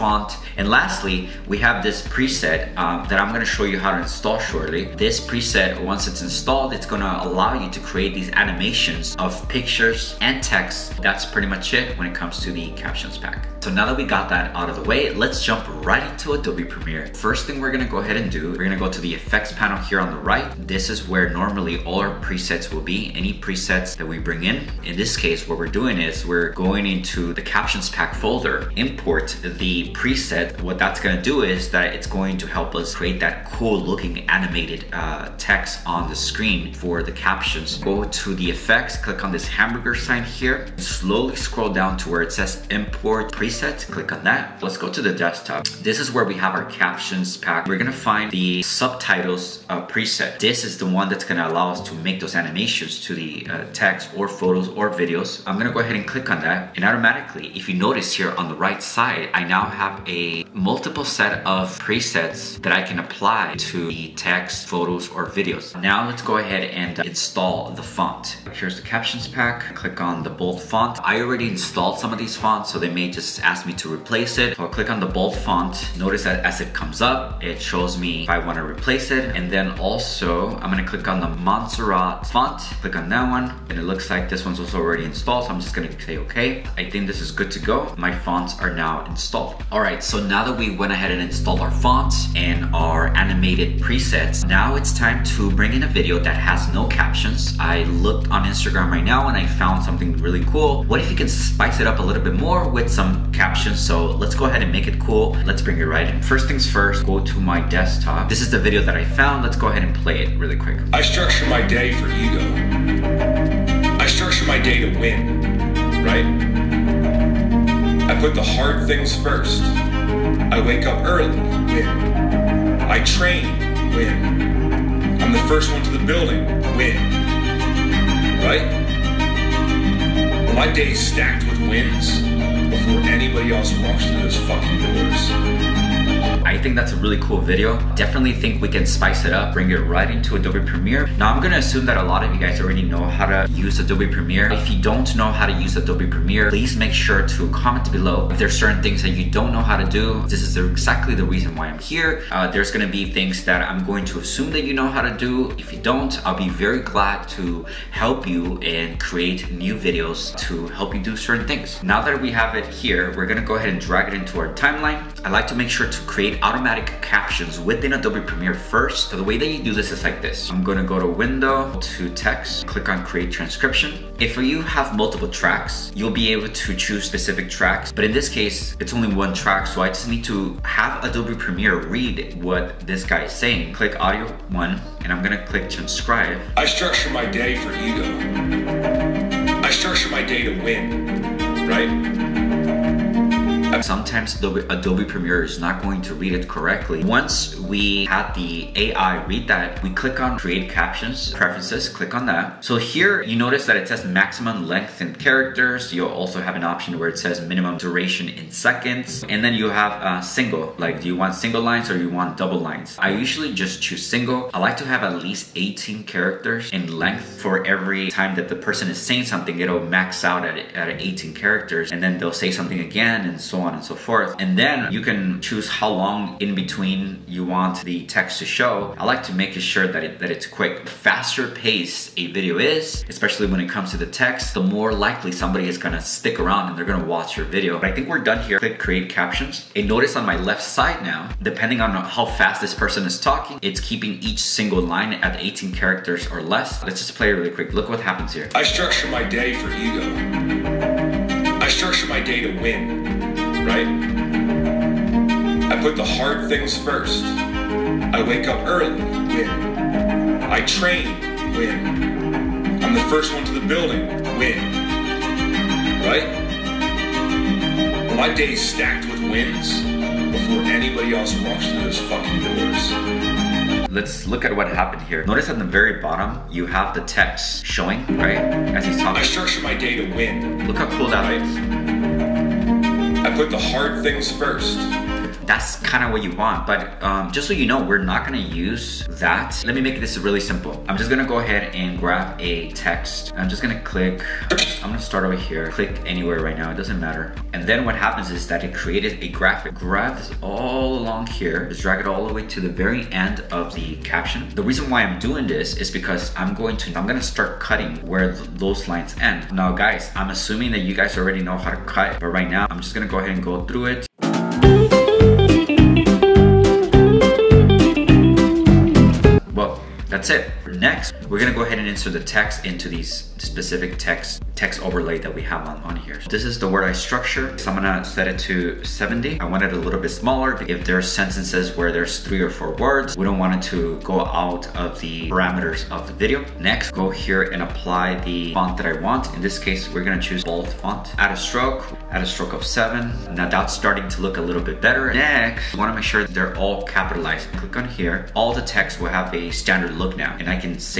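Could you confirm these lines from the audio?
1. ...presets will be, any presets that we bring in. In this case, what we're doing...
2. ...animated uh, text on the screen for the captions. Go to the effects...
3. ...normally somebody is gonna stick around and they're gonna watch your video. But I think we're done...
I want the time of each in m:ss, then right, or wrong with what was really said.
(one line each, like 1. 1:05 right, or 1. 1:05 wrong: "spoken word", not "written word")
1. 0:22 right
2. 0:34 right
3. 3:54 wrong: "likely", not "normally".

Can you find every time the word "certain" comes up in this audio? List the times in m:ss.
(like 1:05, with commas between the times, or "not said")
2:28, 2:41.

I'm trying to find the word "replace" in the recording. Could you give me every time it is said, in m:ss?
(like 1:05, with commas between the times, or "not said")
1:13, 1:18.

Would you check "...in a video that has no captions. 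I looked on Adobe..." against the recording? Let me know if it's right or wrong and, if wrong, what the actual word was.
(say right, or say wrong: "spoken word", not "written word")
wrong: "Instagram", not "Adobe".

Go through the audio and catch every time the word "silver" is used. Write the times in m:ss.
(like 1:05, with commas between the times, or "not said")
not said.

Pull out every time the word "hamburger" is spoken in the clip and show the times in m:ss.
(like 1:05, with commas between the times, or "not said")
0:39.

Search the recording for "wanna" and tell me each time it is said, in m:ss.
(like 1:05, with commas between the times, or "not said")
1:18, 5:45.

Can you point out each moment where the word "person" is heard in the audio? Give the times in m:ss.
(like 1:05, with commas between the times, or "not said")
3:38, 4:02.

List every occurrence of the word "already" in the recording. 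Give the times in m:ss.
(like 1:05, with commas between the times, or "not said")
1:11, 1:24, 2:22, 5:11.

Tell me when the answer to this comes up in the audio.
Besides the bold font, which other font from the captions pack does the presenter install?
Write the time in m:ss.
1:21.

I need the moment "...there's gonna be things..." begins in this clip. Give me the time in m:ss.
2:32.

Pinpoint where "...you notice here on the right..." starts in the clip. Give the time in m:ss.
0:57.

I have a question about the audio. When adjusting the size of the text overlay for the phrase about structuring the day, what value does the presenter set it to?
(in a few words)
70.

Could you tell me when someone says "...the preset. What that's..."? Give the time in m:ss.
0:29.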